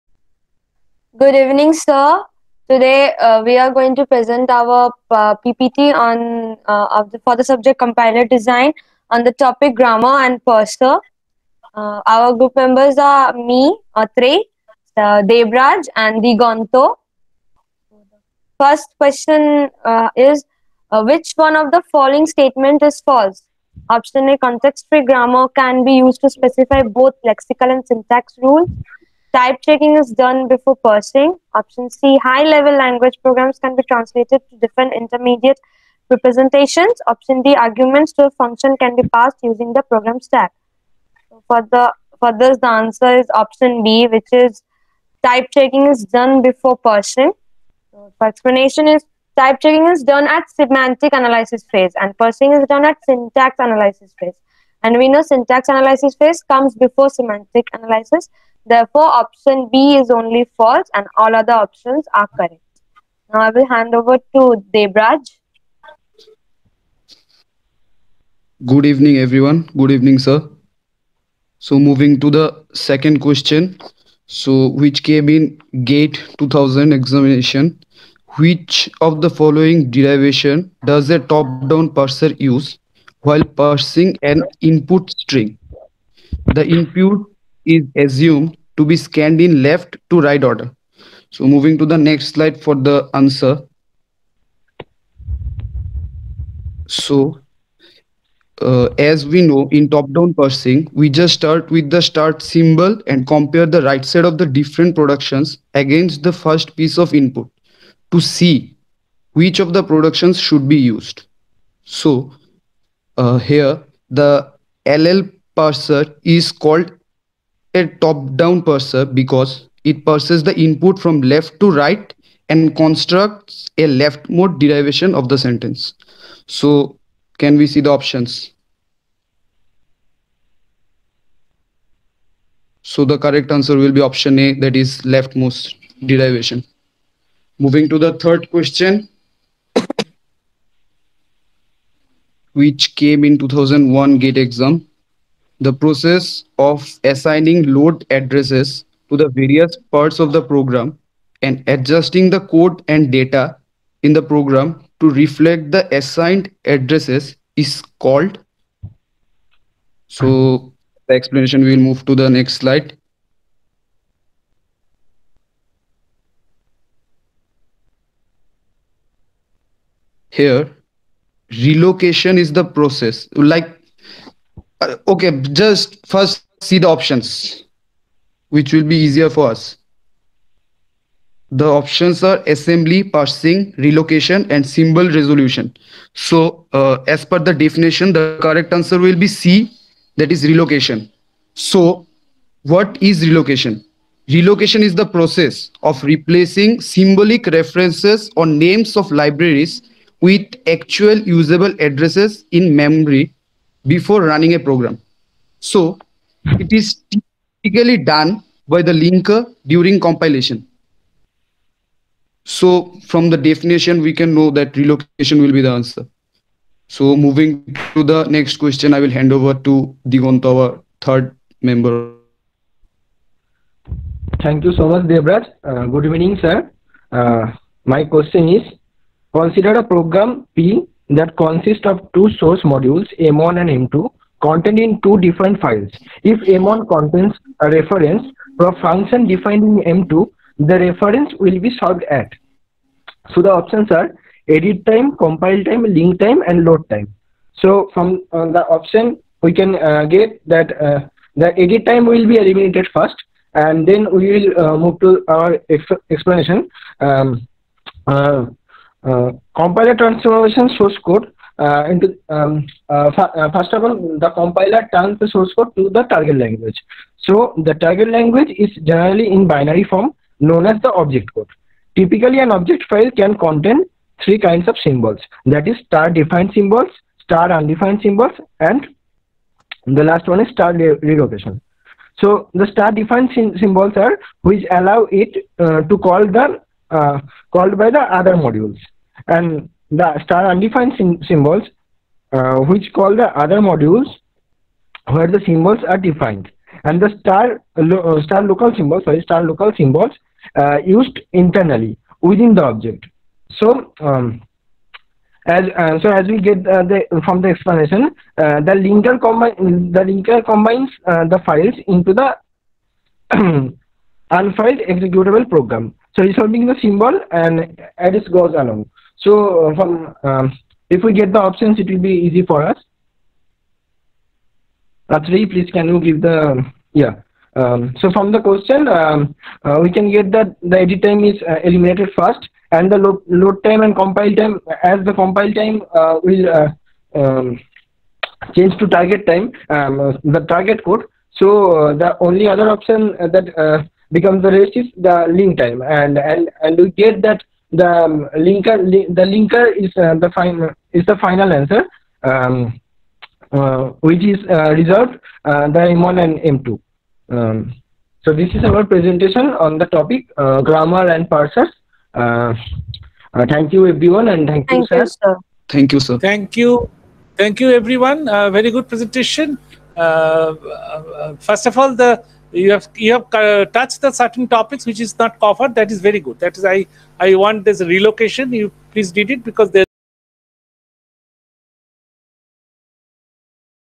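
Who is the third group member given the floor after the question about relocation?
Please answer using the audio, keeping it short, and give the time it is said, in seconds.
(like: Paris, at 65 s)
Digant, at 220 s.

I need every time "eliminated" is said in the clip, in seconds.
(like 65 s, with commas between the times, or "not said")
252 s, 331 s.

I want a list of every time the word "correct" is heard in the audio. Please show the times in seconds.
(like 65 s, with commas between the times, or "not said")
62 s, 133 s, 188 s.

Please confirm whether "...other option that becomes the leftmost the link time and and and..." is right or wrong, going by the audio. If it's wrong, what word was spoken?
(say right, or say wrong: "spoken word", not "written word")
wrong: "resist", not "leftmost".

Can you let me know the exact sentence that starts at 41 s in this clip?
So for, the, for this, the answer is option B, which is type checking is done before parsing.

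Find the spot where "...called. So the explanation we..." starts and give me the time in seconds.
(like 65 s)
157 s.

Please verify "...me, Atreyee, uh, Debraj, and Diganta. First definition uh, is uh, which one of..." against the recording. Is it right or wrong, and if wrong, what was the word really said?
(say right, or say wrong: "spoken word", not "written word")
wrong: "question", not "definition".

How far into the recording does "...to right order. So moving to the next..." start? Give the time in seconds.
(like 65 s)
90 s.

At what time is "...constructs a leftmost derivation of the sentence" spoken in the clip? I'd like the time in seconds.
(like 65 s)
122 s.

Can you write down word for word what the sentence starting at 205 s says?
So it is typically done by the linker during compilation.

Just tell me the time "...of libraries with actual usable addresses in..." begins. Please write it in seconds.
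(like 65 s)
198 s.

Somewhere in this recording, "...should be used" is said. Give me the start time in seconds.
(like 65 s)
110 s.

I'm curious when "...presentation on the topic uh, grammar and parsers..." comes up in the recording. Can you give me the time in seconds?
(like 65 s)
358 s.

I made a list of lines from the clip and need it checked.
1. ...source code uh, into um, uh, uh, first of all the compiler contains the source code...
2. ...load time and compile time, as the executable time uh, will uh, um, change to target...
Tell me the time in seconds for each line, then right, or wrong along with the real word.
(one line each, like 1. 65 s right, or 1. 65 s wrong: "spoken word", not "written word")
1. 260 s wrong: "turns", not "contains"
2. 333 s wrong: "compile", not "executable".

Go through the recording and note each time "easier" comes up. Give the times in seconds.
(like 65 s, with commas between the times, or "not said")
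178 s.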